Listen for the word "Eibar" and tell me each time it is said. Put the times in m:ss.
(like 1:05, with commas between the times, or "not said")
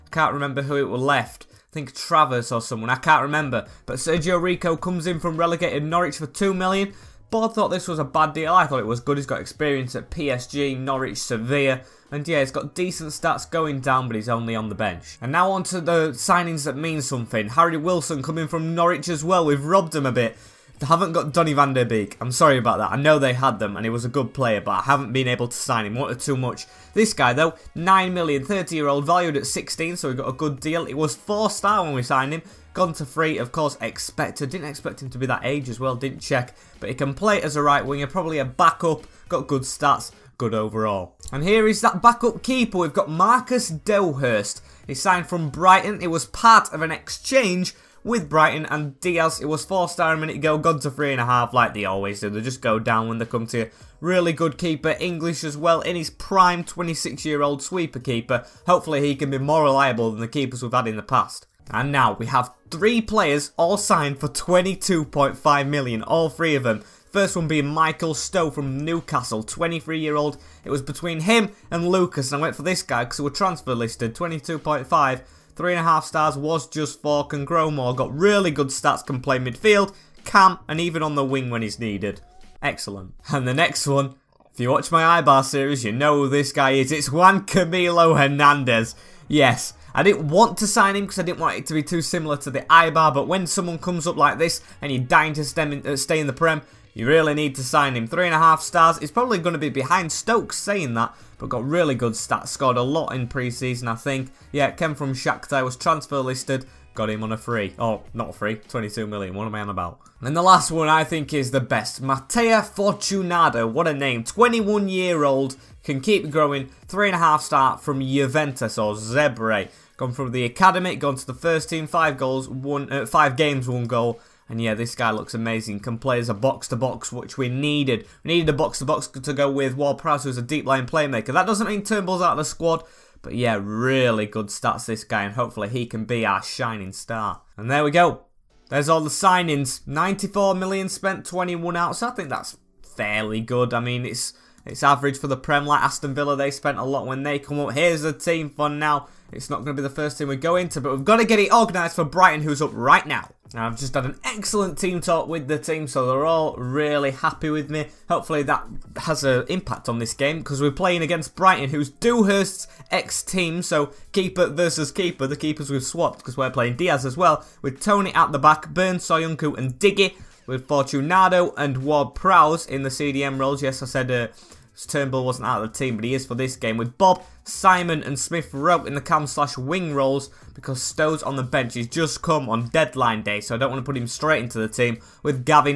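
1:25, 1:32.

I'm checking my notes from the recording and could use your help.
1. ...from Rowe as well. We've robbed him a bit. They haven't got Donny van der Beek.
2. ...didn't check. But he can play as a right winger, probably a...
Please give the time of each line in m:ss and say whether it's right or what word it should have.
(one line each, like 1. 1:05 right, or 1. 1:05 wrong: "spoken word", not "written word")
1. 0:18 wrong: "Norwich", not "Rowe"
2. 0:35 right.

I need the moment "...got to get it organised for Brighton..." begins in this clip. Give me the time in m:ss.
2:31.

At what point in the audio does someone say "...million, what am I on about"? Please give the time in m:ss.
1:49.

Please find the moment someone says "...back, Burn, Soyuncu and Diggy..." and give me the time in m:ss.
2:48.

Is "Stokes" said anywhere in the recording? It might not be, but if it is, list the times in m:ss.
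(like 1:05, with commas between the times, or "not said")
1:40.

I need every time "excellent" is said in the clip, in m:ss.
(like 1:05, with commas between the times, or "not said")
1:22, 2:34.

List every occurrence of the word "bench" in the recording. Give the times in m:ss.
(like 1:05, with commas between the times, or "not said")
0:14, 3:01.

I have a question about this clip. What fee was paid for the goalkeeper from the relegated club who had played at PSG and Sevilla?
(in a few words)
2 million.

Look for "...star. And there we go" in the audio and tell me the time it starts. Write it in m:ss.
2:16.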